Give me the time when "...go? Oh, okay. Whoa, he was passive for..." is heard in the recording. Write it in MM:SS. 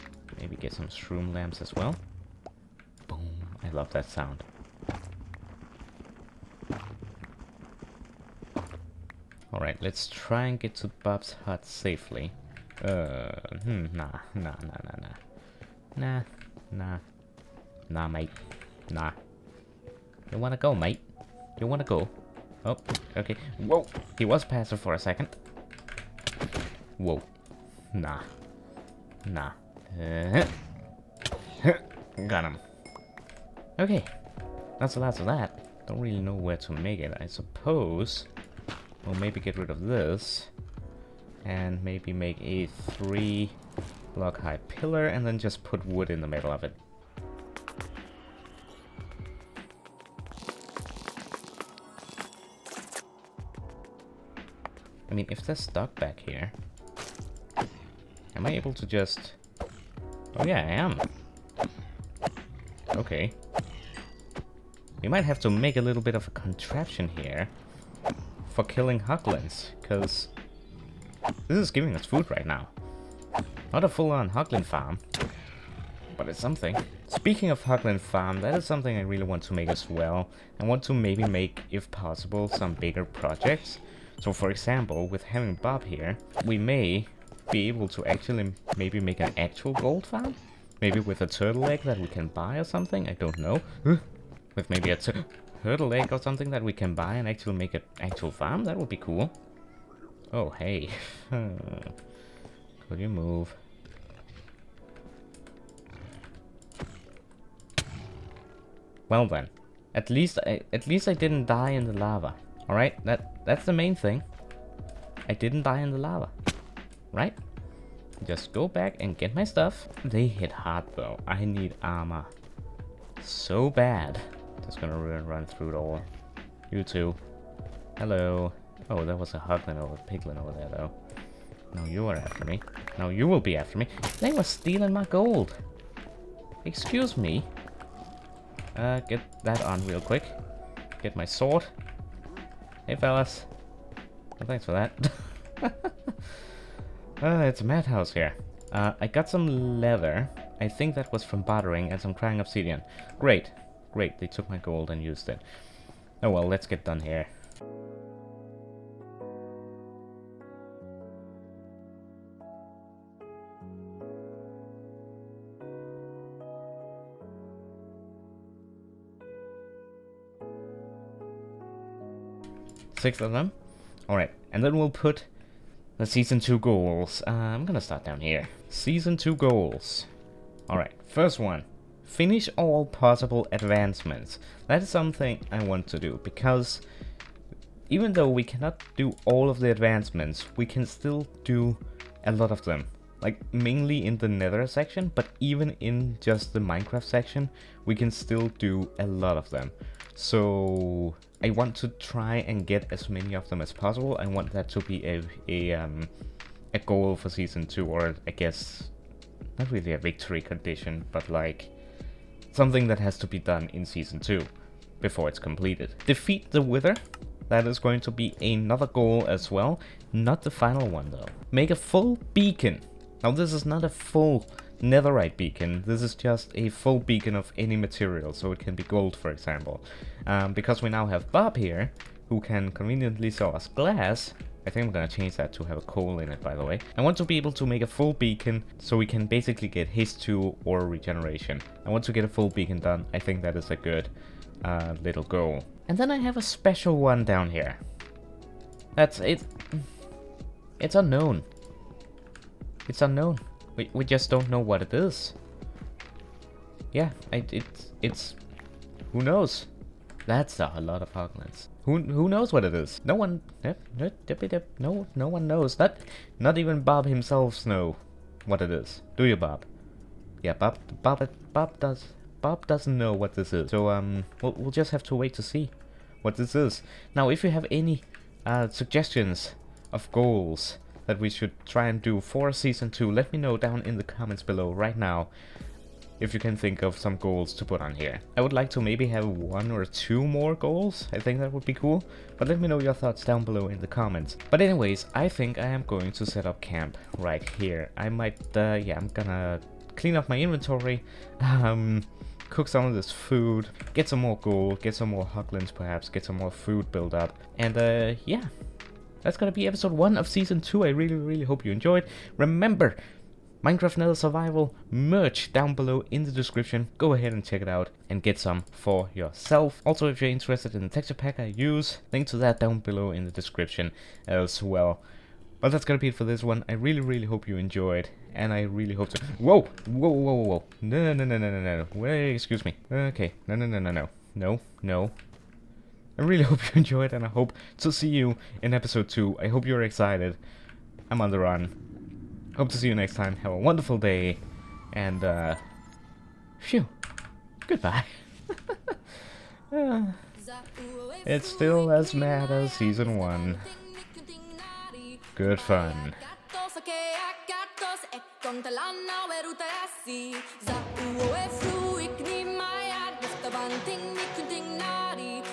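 00:21.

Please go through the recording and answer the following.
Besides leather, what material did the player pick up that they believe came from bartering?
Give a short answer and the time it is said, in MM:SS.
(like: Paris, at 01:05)
Crying obsidian, at 02:32.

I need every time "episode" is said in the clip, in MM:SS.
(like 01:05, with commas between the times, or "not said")
05:09, 05:38.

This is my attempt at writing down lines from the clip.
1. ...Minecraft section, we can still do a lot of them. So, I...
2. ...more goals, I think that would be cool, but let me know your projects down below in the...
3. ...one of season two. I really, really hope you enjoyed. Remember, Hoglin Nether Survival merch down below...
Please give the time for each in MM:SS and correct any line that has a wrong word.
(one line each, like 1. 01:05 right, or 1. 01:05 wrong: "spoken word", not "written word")
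1. 03:16 right
2. 04:50 wrong: "thoughts", not "projects"
3. 05:09 wrong: "Minecraft", not "Hoglin".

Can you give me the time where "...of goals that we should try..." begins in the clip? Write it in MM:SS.
04:39.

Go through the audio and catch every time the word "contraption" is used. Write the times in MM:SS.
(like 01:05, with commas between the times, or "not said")
01:06.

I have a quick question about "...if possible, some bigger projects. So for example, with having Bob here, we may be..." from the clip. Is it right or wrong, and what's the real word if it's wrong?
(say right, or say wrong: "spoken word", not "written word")
right.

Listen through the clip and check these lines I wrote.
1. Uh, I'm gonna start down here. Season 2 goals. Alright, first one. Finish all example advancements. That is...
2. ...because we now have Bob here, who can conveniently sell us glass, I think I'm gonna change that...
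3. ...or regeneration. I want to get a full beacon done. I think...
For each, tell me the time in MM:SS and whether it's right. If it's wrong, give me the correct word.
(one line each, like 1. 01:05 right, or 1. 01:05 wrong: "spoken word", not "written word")
1. 02:57 wrong: "possible", not "example"
2. 03:50 right
3. 04:00 right.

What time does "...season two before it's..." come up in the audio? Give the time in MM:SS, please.
03:33.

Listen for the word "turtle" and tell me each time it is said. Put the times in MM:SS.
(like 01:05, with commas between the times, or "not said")
01:31, 01:35.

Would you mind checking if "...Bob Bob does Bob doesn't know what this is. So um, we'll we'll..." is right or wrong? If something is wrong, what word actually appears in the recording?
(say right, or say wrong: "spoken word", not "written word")
right.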